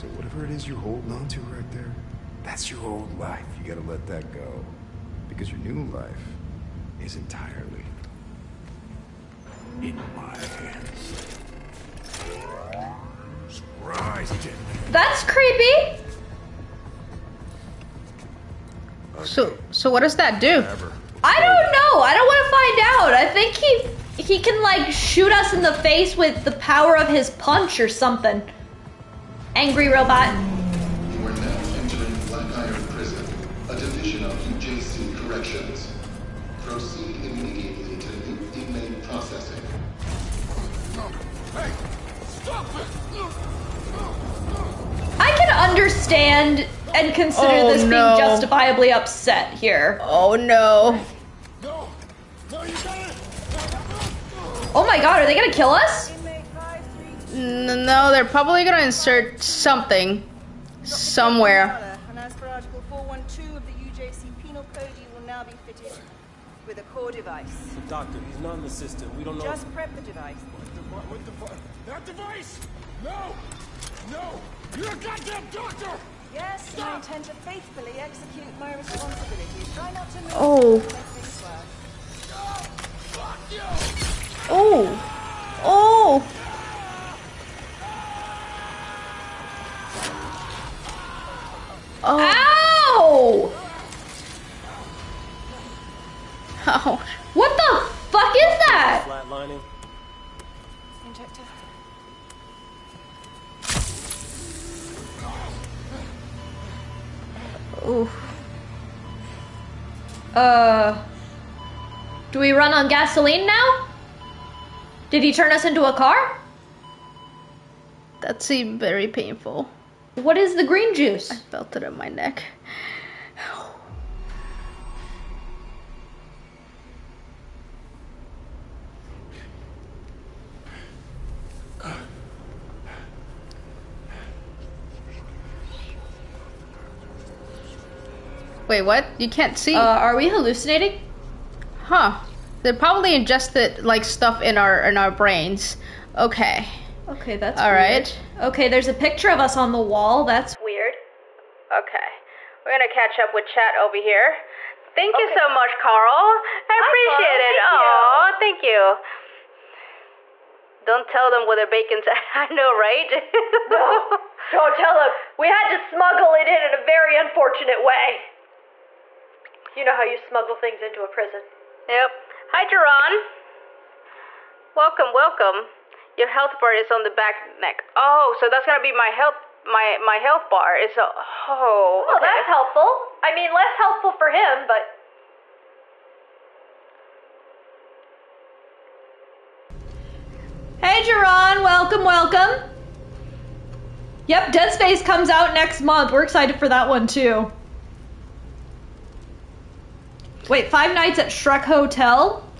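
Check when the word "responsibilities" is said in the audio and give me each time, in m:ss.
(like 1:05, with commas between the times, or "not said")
1:18.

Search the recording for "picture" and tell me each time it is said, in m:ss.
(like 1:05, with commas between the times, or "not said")
2:28.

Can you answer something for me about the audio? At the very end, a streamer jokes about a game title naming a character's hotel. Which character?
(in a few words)
Shrek.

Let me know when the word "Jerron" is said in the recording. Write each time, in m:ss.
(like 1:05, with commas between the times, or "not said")
3:11.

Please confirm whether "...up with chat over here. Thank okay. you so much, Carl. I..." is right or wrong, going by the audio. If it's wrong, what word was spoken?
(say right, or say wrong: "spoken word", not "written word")
right.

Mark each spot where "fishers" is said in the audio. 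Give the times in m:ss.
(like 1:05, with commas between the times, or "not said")
not said.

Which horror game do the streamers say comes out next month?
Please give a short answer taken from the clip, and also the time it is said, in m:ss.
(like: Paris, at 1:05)
Dead Space, at 3:14.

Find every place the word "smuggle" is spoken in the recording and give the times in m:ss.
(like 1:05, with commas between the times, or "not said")
2:45, 2:50.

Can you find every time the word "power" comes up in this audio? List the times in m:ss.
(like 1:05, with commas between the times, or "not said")
0:26.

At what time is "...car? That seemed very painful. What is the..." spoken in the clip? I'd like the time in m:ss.
1:55.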